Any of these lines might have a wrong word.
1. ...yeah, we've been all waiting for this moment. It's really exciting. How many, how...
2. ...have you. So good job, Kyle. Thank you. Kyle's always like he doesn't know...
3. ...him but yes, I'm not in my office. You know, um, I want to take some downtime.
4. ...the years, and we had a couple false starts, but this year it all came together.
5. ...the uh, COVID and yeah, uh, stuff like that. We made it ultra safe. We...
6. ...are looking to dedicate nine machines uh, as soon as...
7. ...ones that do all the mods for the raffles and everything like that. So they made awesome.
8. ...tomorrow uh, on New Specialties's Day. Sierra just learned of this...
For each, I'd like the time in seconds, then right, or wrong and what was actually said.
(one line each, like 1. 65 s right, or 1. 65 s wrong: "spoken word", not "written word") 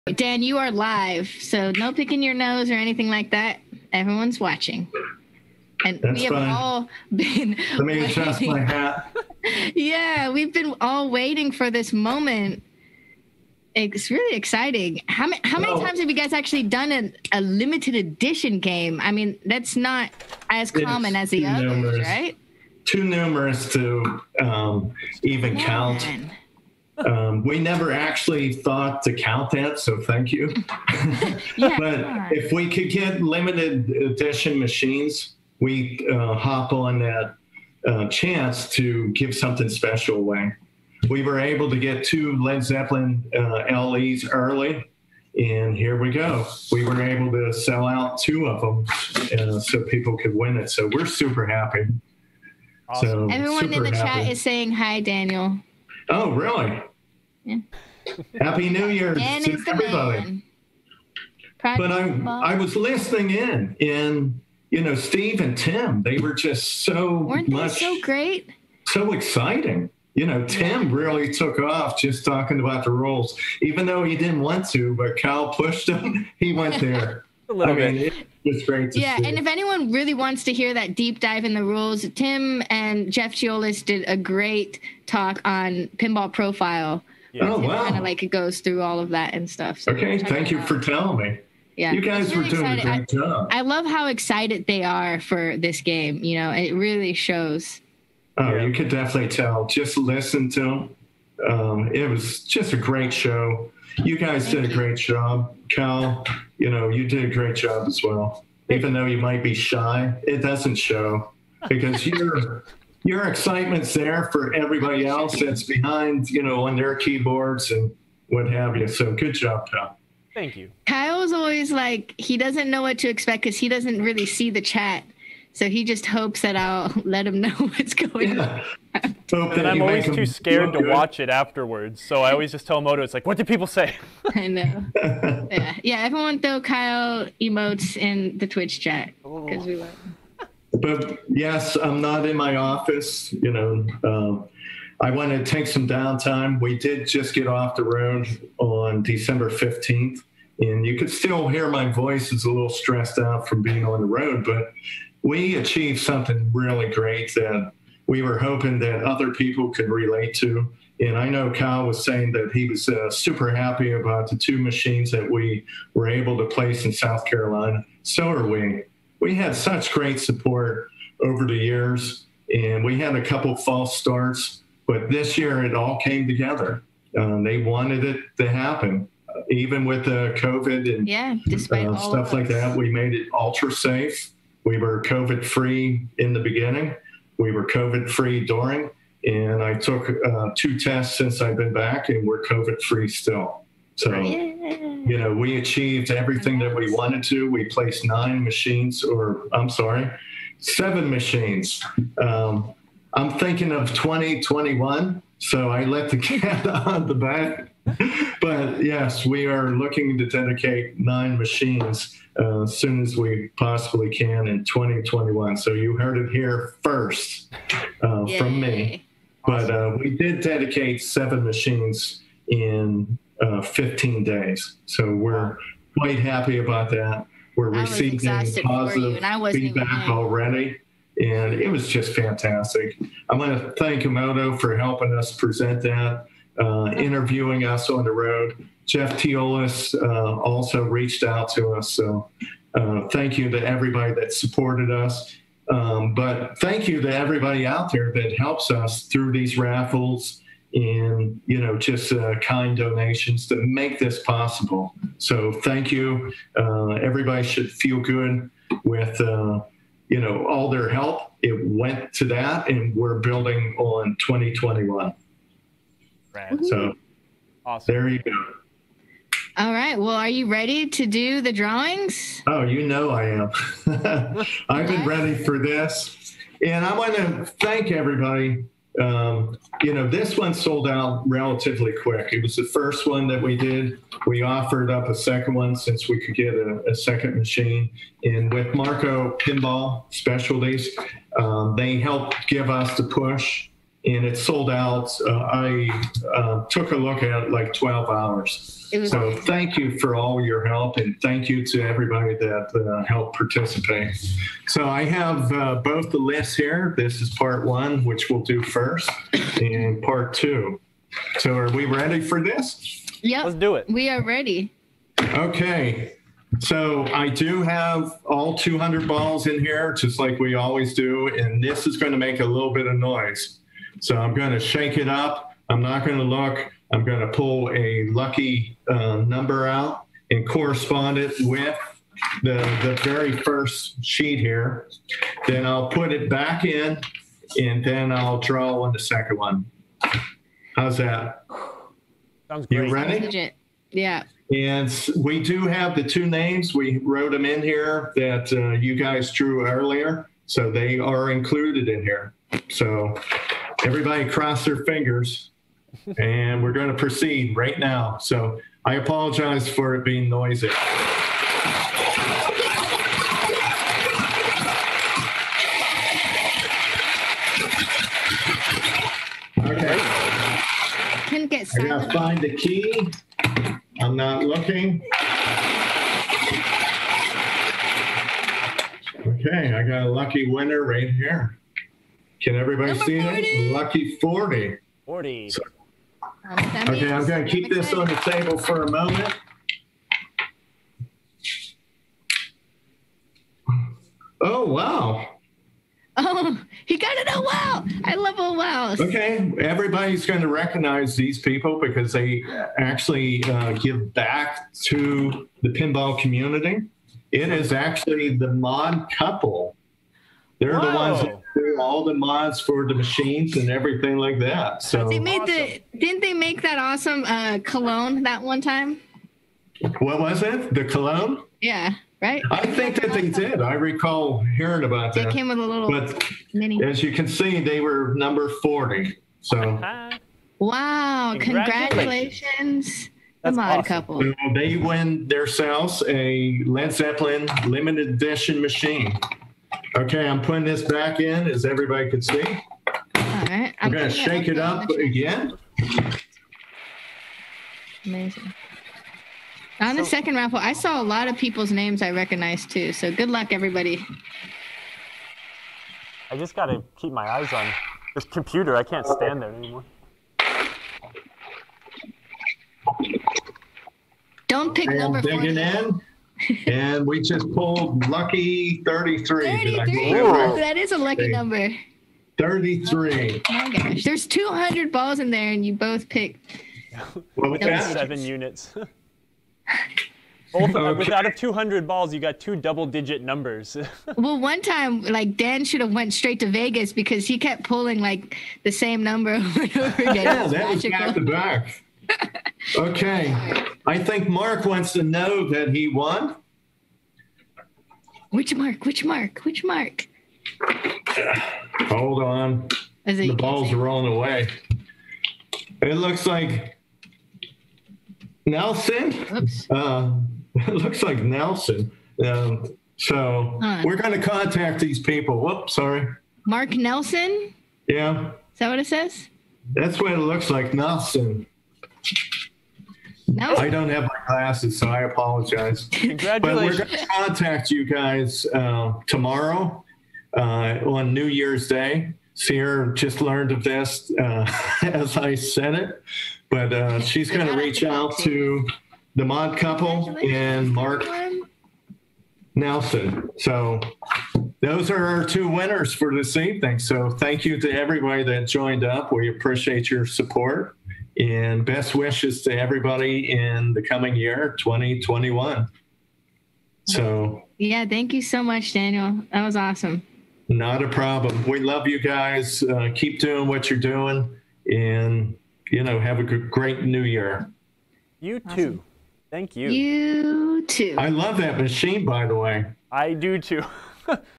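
1. 9 s right
2. 118 s right
3. 139 s right
4. 171 s right
5. 180 s right
6. 209 s right
7. 410 s wrong: "machines", not "raffles"
8. 529 s wrong: "Year", not "Specialties".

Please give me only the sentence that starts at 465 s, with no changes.
Digging in and we just pulled lucky 33.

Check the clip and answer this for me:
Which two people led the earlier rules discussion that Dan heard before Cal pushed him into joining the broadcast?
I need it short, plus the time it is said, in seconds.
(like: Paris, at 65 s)
Steve and Tim, at 64 s.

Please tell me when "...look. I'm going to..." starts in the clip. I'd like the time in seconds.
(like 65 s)
326 s.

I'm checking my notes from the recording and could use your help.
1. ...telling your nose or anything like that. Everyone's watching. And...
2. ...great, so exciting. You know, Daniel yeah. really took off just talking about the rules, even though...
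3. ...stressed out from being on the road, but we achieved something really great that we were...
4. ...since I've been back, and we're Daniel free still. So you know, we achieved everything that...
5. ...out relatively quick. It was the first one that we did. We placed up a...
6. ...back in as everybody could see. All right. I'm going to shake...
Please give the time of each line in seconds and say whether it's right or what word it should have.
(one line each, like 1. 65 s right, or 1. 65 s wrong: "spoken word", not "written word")
1. 1 s wrong: "picking", not "telling"
2. 68 s wrong: "Tim", not "Daniel"
3. 152 s right
4. 191 s wrong: "COVID", not "Daniel"
5. 280 s wrong: "offered", not "placed"
6. 440 s right.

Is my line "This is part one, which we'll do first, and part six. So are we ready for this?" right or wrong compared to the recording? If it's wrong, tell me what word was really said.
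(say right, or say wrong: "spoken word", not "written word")
wrong: "two", not "six".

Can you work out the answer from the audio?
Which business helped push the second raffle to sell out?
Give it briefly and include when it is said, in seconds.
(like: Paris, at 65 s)
Marco Pinball Specialties, at 288 s.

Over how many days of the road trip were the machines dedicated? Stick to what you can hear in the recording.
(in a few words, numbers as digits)
15.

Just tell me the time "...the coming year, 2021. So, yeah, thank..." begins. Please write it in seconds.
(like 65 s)
553 s.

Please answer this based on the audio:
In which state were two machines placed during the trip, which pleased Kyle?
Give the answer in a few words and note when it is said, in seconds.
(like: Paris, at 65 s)
South Carolina, at 166 s.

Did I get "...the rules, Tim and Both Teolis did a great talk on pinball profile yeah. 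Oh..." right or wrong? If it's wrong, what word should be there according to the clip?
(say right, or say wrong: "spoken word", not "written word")
wrong: "Jeff", not "Both".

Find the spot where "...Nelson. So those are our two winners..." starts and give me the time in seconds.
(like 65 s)
542 s.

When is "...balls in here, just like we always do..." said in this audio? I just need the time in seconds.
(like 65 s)
319 s.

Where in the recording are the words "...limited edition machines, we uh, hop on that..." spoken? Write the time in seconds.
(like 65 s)
33 s.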